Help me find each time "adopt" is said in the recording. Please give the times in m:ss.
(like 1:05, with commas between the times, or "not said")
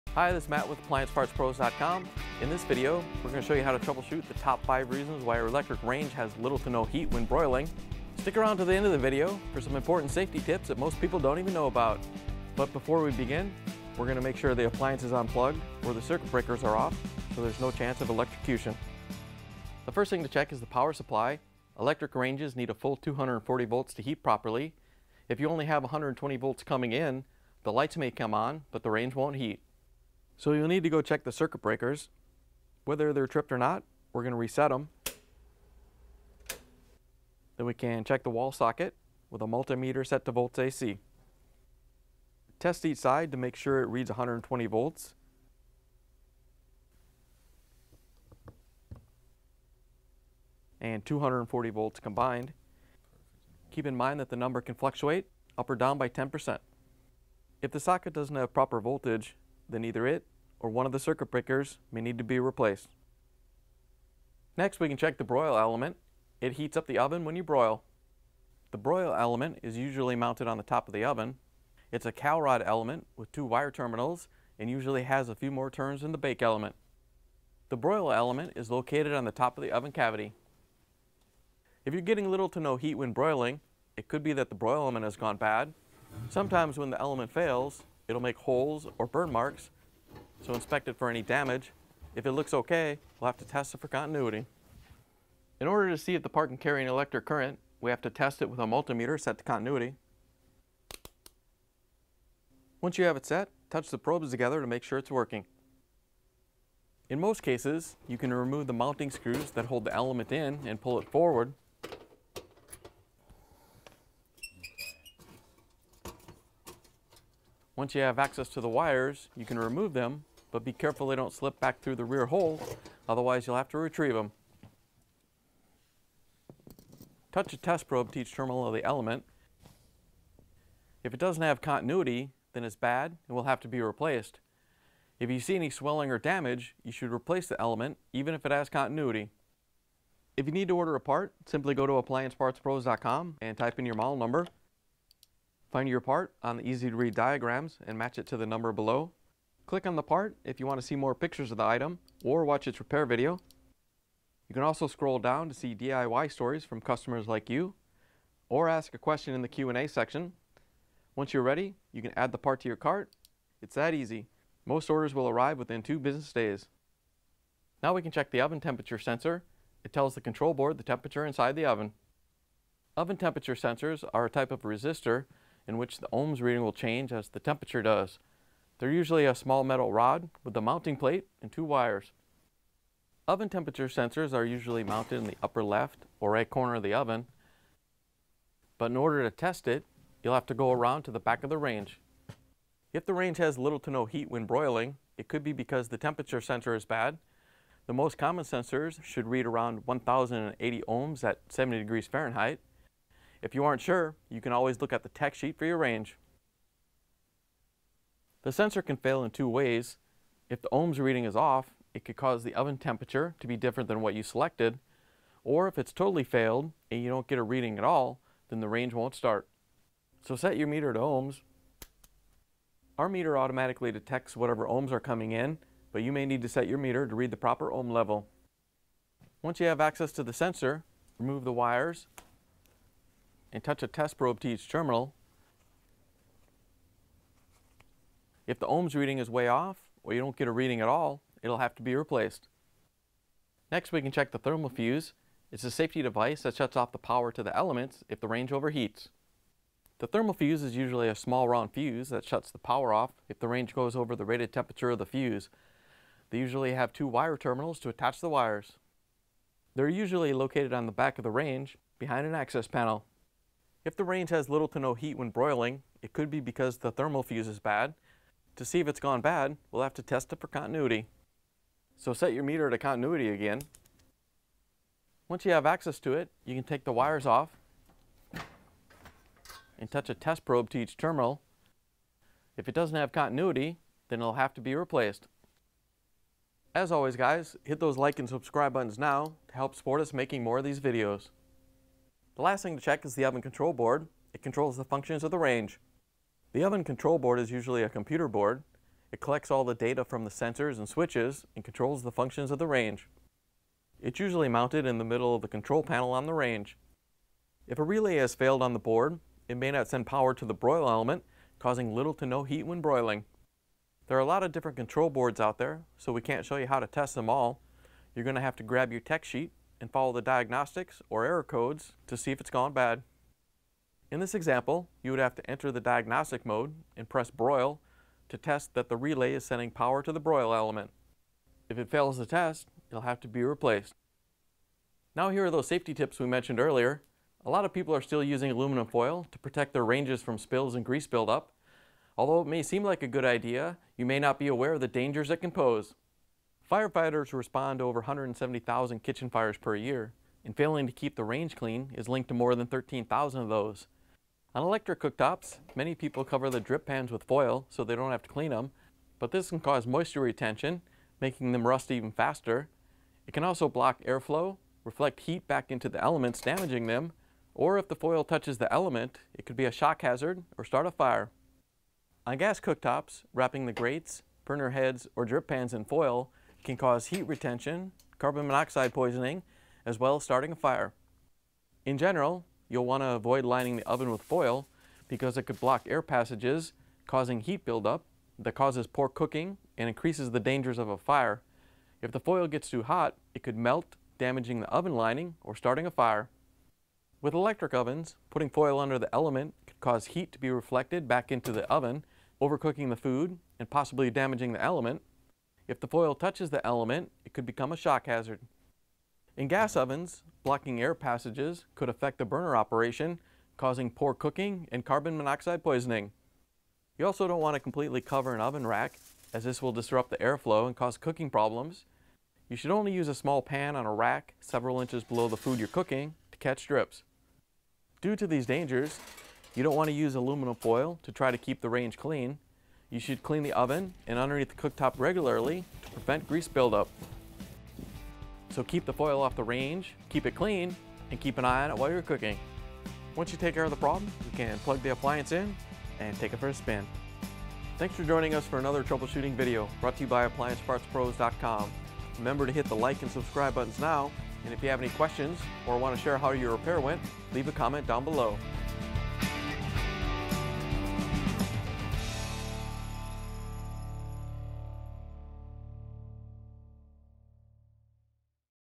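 not said.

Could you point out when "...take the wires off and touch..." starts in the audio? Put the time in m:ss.
4:36.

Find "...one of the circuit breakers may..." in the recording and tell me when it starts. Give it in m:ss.
1:00.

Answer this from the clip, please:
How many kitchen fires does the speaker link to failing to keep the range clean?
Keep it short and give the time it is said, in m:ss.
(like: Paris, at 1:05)
13,000, at 5:52.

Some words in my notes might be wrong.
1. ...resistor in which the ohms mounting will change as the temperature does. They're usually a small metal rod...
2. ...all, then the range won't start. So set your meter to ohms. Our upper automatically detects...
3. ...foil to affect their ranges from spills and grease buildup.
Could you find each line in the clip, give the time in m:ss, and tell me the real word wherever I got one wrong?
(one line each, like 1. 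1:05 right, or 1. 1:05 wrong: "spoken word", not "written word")
1. 2:54 wrong: "reading", not "mounting"
2. 3:37 wrong: "meter", not "upper"
3. 5:38 wrong: "protect", not "affect".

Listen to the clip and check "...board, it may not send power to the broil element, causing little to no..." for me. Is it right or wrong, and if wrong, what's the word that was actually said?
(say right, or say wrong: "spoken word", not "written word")
right.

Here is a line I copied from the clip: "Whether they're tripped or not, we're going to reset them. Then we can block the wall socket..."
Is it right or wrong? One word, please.
wrong.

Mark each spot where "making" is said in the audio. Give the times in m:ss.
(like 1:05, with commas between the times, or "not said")
4:50, 6:01.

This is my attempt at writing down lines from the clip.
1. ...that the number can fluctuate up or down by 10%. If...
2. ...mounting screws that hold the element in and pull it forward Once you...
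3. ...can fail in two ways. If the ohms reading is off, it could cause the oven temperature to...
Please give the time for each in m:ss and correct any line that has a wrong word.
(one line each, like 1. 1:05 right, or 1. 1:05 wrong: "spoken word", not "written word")
1. 0:54 right
2. 1:48 right
3. 3:28 right.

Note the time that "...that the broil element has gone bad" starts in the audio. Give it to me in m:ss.
1:24.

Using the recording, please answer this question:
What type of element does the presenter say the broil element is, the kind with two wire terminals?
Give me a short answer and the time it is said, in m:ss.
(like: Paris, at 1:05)
Calrod, at 1:12.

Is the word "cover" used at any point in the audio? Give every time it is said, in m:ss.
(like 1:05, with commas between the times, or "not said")
5:56, 6:58.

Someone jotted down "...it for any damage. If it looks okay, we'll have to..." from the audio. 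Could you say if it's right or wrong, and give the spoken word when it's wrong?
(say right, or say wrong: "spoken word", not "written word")
right.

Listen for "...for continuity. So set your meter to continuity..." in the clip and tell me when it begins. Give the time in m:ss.
4:30.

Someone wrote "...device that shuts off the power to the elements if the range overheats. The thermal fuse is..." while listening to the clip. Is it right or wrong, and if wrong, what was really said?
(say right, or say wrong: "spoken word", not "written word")
right.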